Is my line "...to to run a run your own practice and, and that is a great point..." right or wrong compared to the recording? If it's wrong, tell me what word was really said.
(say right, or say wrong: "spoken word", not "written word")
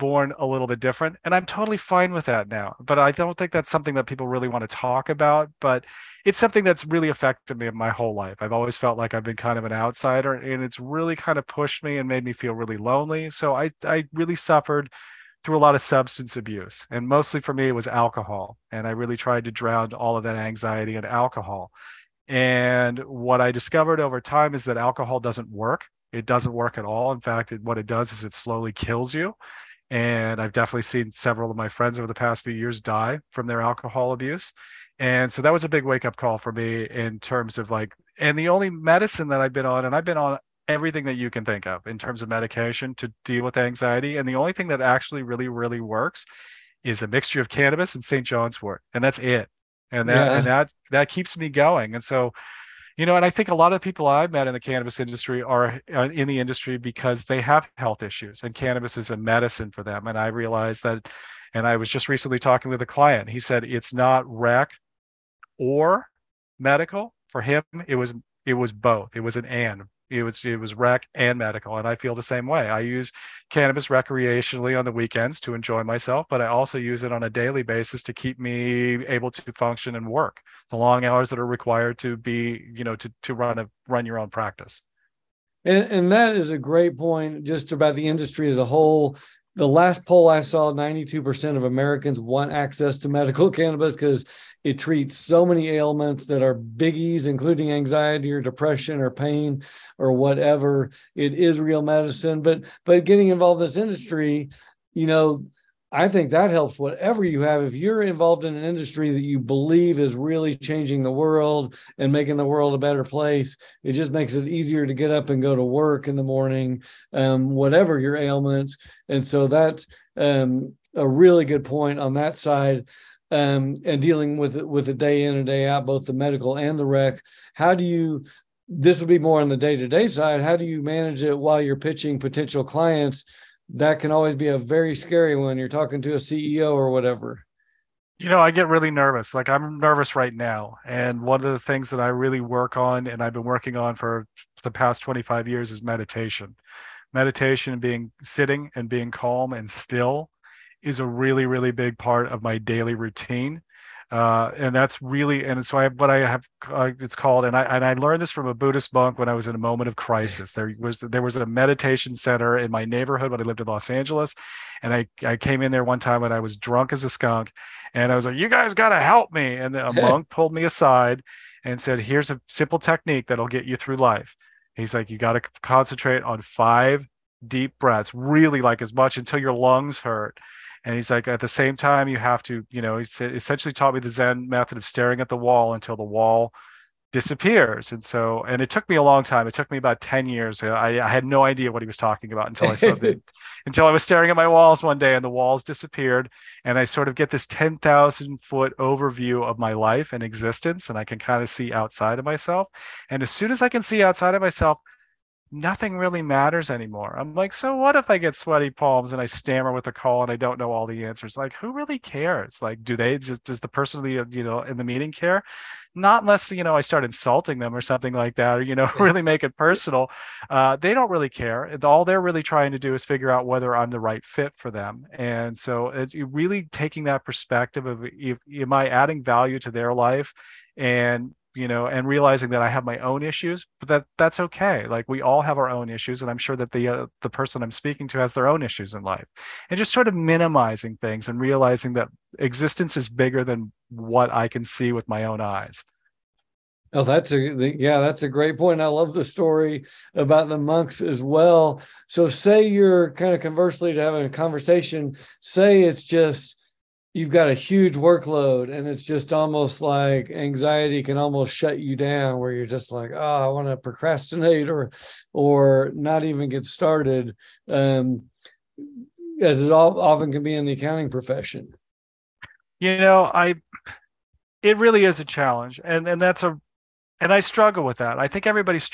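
right.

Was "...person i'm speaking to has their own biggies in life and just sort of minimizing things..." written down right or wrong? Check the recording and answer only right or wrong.
wrong.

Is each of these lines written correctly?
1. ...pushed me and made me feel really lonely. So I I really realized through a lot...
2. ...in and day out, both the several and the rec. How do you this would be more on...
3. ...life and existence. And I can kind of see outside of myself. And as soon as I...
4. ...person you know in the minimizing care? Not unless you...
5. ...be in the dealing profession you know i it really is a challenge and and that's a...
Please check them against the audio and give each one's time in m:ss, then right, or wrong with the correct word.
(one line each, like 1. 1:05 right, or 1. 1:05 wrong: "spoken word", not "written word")
1. 0:11 wrong: "suffered", not "realized"
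2. 2:05 wrong: "medical", not "several"
3. 3:19 right
4. 3:33 wrong: "meeting", not "minimizing"
5. 4:30 wrong: "accounting", not "dealing".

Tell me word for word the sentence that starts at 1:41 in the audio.
It is real medicine, but but getting involved in this industry, you know, I think that helps whatever you have.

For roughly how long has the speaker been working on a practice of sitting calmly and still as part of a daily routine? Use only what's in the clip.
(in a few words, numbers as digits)
25 years.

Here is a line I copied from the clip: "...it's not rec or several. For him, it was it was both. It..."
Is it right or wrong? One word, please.
wrong.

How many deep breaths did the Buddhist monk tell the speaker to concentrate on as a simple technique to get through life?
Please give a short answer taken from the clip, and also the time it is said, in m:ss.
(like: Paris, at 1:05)
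5, at 2:56.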